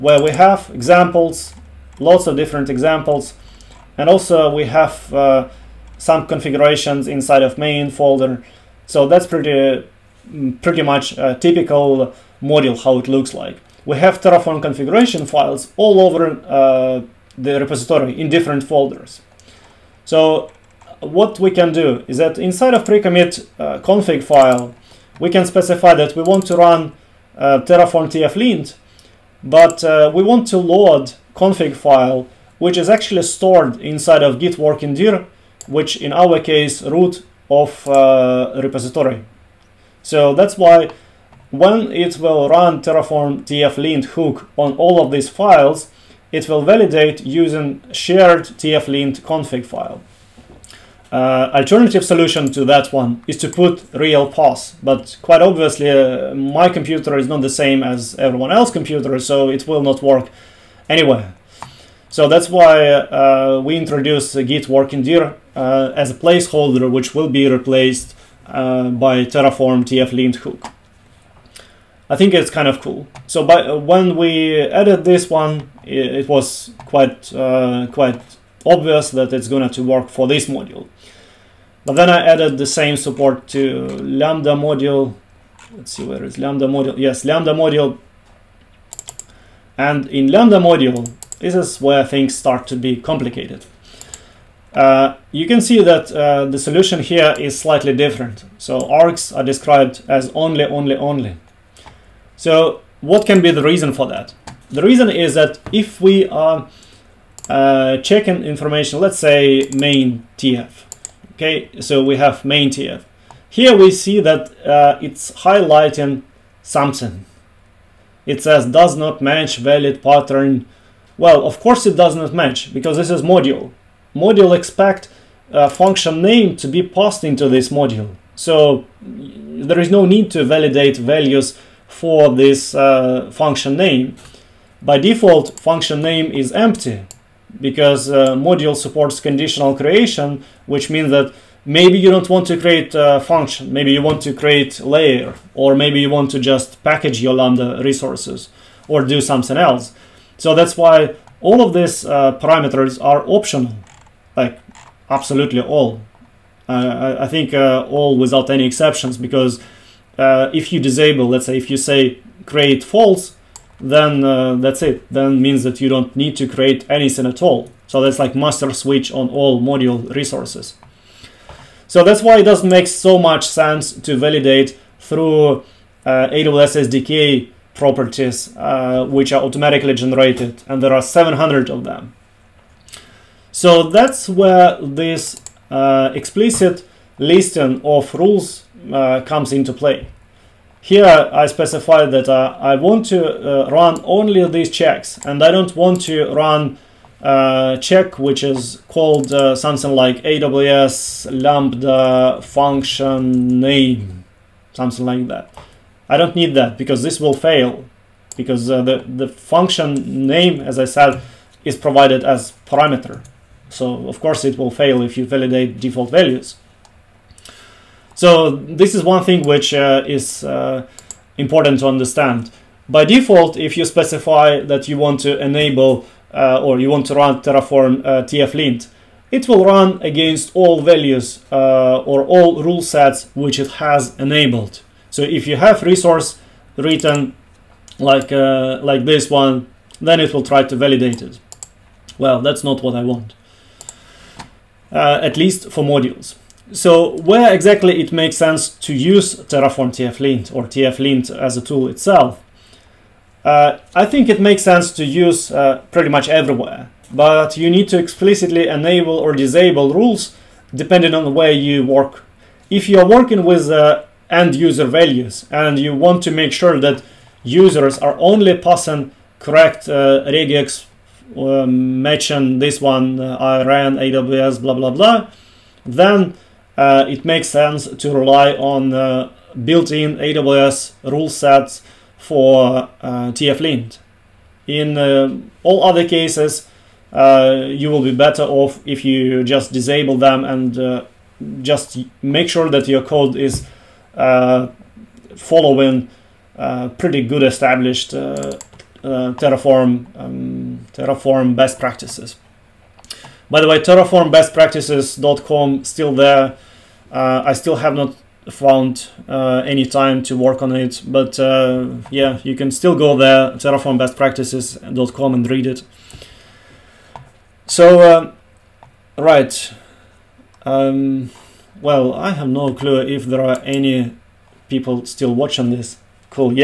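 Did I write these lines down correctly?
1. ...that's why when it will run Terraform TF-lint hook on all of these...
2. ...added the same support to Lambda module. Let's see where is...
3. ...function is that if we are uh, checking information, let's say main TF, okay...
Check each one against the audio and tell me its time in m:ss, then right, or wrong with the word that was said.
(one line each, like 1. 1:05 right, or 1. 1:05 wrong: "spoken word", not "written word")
1. 0:40 right
2. 1:22 right
3. 1:44 wrong: "reason", not "function".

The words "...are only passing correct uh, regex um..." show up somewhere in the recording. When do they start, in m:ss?
4:27.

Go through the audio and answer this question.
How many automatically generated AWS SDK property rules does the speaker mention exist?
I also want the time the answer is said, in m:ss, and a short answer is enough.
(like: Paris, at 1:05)
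700, at 3:01.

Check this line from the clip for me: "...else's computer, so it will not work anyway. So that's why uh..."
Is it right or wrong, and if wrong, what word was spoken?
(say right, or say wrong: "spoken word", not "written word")
right.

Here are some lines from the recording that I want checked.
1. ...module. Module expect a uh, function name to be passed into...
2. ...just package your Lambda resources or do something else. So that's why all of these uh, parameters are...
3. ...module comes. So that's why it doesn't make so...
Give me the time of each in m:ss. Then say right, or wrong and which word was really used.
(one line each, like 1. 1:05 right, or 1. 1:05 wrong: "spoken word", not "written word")
1. 2:03 right
2. 2:26 right
3. 2:49 wrong: "resources", not "comes".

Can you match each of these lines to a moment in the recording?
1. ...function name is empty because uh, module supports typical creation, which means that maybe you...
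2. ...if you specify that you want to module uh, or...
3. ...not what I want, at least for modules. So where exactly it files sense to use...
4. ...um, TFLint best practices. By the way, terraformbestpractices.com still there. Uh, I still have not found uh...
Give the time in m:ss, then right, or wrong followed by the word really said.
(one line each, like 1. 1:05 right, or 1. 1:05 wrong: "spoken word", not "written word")
1. 2:15 wrong: "conditional", not "typical"
2. 3:43 wrong: "enable", not "module"
3. 4:02 wrong: "makes", not "files"
4. 5:00 wrong: "Terraform", not "TFLint".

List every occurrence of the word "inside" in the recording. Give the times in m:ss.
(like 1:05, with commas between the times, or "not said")
0:07, 0:22, 0:33.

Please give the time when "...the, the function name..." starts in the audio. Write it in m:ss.
3:28.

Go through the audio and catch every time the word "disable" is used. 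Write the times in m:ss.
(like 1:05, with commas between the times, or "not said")
2:40, 4:19, 4:49.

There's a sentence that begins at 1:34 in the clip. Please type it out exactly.
Uh, you can see that uh, the solution here is slightly different.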